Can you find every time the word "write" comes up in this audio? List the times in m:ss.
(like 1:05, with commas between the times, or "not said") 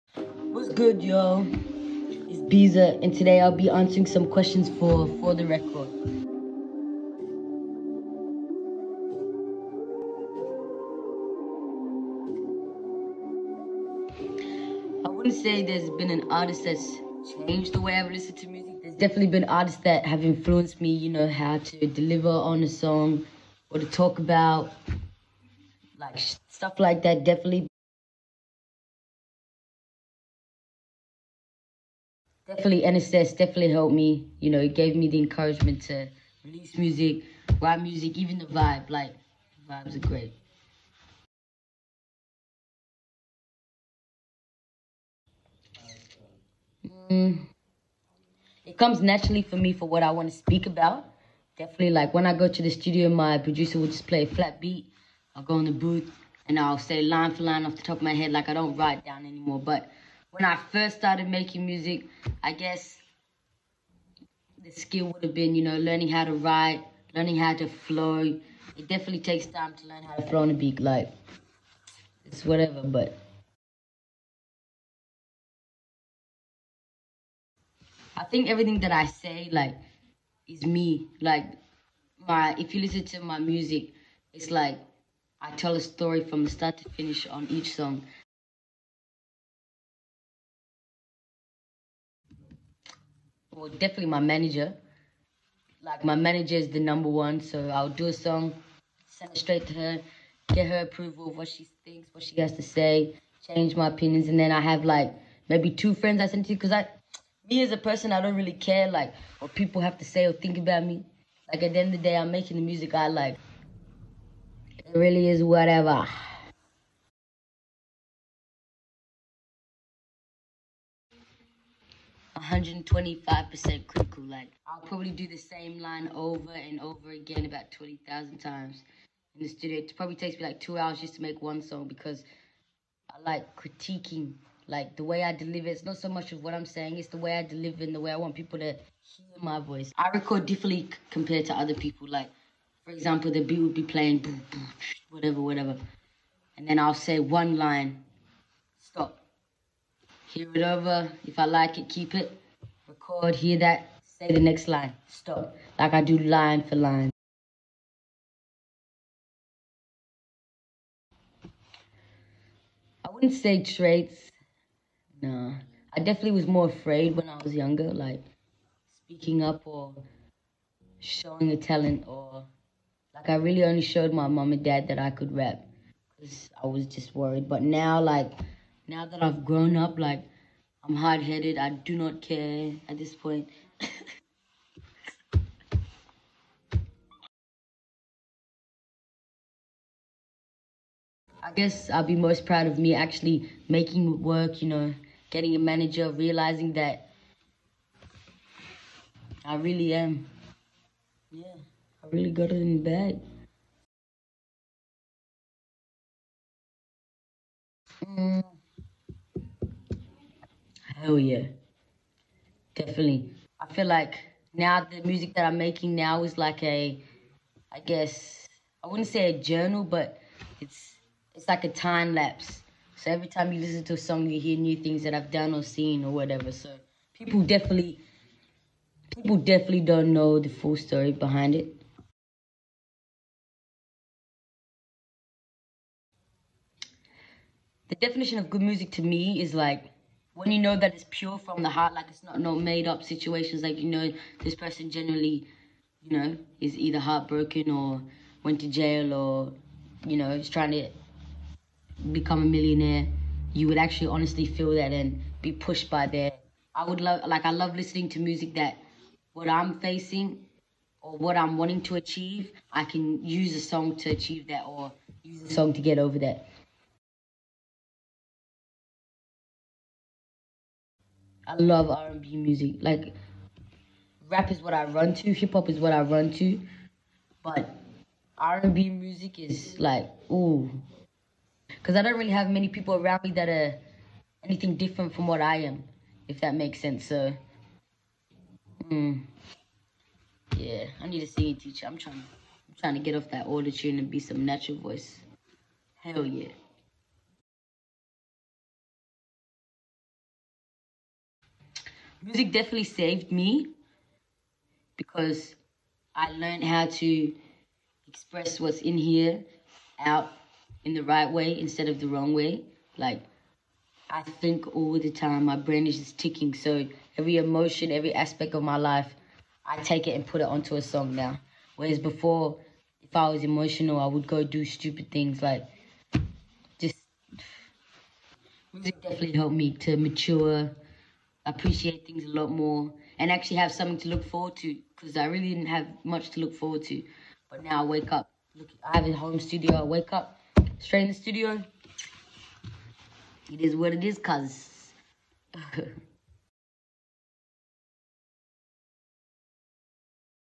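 0:37, 0:58, 1:06.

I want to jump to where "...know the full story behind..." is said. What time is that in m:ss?
3:50.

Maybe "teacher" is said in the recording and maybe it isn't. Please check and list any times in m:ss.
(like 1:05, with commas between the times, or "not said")
4:51.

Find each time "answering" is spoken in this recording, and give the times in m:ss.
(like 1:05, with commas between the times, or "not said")
0:03.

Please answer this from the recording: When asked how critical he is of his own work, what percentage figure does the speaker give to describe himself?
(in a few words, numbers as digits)
125%.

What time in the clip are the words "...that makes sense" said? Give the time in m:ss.
4:46.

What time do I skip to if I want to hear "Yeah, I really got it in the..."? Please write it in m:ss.
3:21.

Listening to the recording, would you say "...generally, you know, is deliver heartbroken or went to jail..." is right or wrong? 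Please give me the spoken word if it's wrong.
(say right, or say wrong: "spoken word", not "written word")
wrong: "either", not "deliver".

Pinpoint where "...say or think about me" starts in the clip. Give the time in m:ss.
1:50.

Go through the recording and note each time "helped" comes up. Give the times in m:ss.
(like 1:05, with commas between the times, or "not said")
0:33, 5:29.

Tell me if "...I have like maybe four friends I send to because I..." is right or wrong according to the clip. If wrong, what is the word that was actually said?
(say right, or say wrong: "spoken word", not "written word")
wrong: "two", not "four".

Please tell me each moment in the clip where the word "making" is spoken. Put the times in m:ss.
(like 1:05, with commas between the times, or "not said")
1:01, 1:52, 3:13, 3:35.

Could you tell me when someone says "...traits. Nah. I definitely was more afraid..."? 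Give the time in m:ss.
2:43.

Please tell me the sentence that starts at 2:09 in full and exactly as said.
It probably takes me like two hours just to make one song because I like critiquing, like the way I deliver.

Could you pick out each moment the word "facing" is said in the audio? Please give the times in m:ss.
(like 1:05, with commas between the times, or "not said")
4:19.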